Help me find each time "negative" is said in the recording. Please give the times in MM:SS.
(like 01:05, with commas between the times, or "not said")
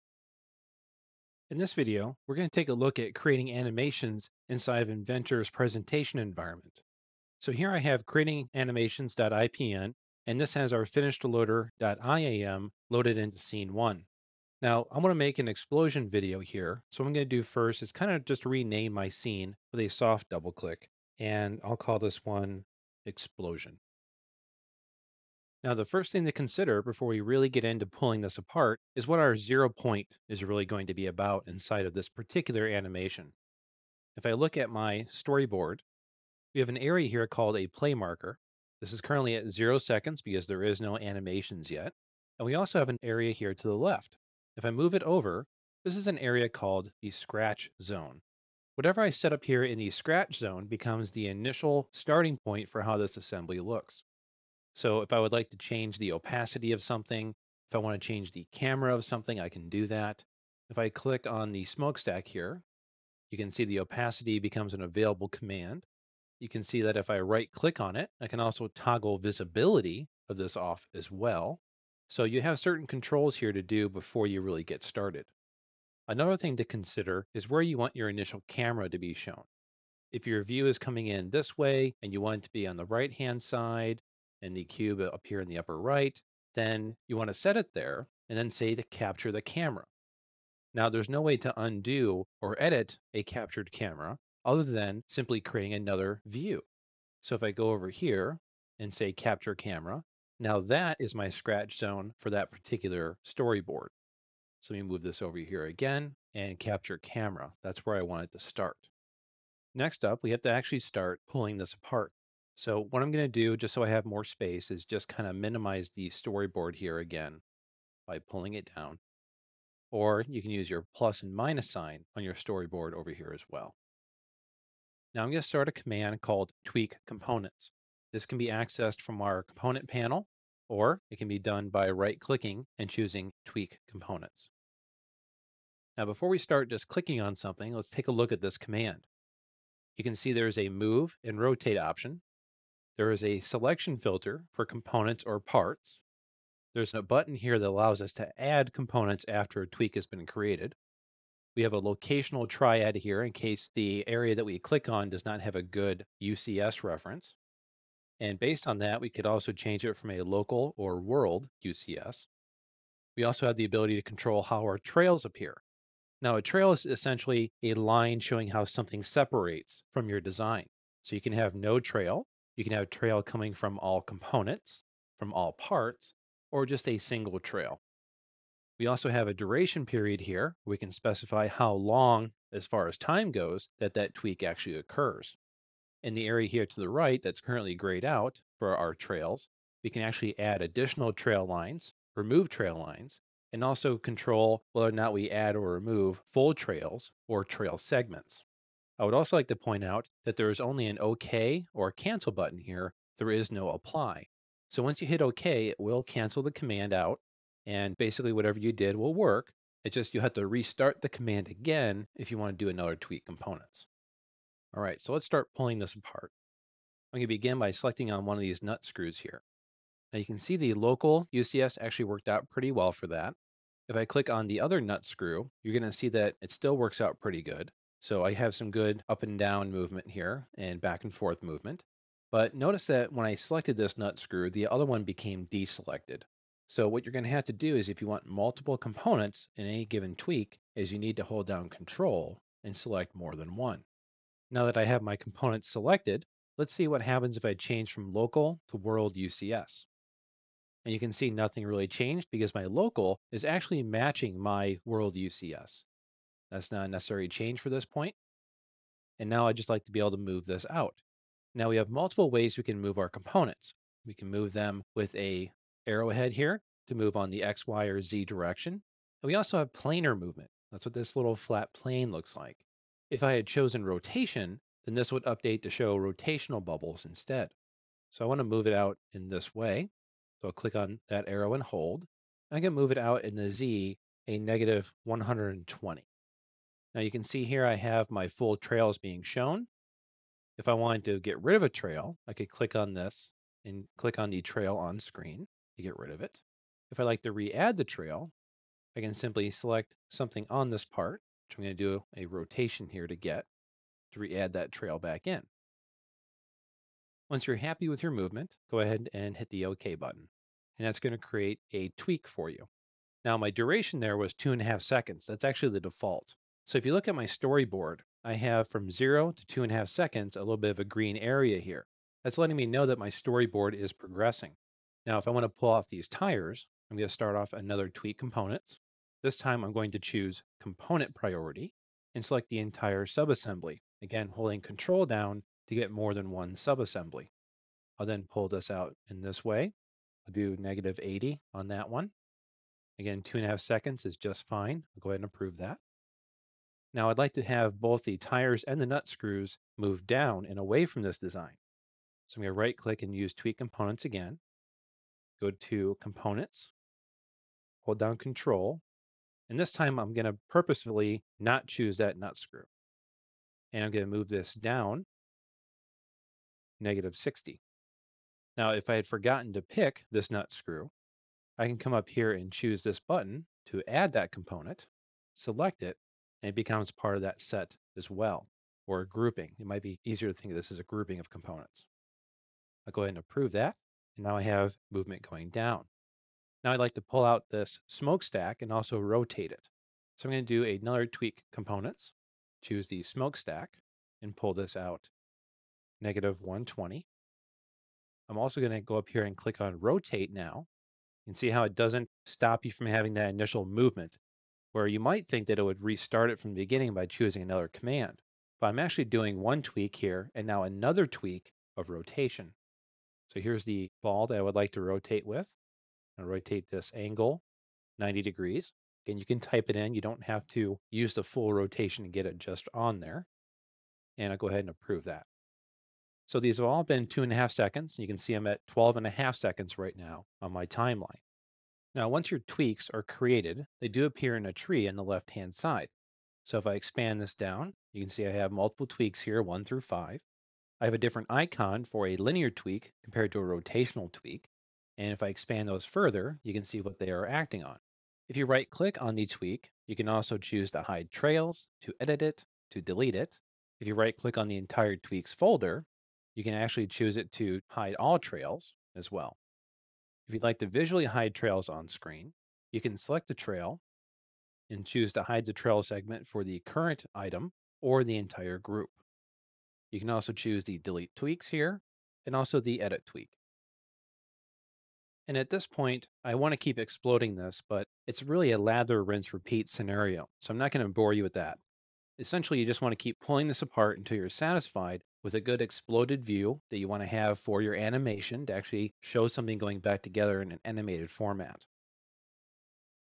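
04:44, 05:40, 06:06, 06:36.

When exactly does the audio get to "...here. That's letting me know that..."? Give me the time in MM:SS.
05:21.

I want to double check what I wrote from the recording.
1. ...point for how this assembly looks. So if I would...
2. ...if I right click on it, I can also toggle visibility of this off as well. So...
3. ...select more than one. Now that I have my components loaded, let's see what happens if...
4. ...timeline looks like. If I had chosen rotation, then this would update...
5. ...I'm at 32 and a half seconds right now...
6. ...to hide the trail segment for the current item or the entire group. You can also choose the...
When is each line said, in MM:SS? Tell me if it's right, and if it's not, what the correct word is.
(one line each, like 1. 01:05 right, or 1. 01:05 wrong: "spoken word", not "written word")
1. 00:52 right
2. 01:06 right
3. 04:02 wrong: "selected", not "loaded"
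4. 04:31 wrong: "plane", not "timeline"
5. 07:08 wrong: "12", not "32"
6. 07:45 right.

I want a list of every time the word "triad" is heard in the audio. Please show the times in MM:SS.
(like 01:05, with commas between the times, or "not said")
02:32.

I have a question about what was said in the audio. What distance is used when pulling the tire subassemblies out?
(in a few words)
-80.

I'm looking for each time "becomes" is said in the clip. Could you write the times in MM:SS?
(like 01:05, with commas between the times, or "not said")
00:50, 01:04, 06:16.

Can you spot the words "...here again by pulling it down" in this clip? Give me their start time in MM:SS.
01:56.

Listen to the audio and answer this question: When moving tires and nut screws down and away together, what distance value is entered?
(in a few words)
-60.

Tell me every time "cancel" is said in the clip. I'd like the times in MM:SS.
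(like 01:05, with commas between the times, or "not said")
03:21, 03:26.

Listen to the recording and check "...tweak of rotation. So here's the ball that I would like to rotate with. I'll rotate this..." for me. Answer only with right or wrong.
right.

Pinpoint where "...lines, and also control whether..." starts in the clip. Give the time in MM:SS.
03:12.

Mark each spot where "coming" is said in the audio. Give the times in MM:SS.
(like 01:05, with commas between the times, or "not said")
01:20, 02:53.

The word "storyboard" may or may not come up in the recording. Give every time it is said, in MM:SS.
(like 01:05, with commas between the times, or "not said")
00:35, 01:43, 01:56, 02:02, 05:17, 05:23.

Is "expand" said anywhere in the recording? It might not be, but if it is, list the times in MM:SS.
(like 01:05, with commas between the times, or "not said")
07:16, 07:25.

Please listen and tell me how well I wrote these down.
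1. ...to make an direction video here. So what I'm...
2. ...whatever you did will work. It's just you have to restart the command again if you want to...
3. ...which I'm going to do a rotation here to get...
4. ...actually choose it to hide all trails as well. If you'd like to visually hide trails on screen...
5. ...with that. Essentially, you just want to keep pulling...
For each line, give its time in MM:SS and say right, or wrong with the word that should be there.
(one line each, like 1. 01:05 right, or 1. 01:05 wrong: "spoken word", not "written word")
1. 00:15 wrong: "explosion", not "direction"
2. 03:28 right
3. 05:01 right
4. 07:36 right
5. 08:01 right.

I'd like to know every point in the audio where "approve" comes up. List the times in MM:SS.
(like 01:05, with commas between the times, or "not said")
05:45, 06:23, 07:04.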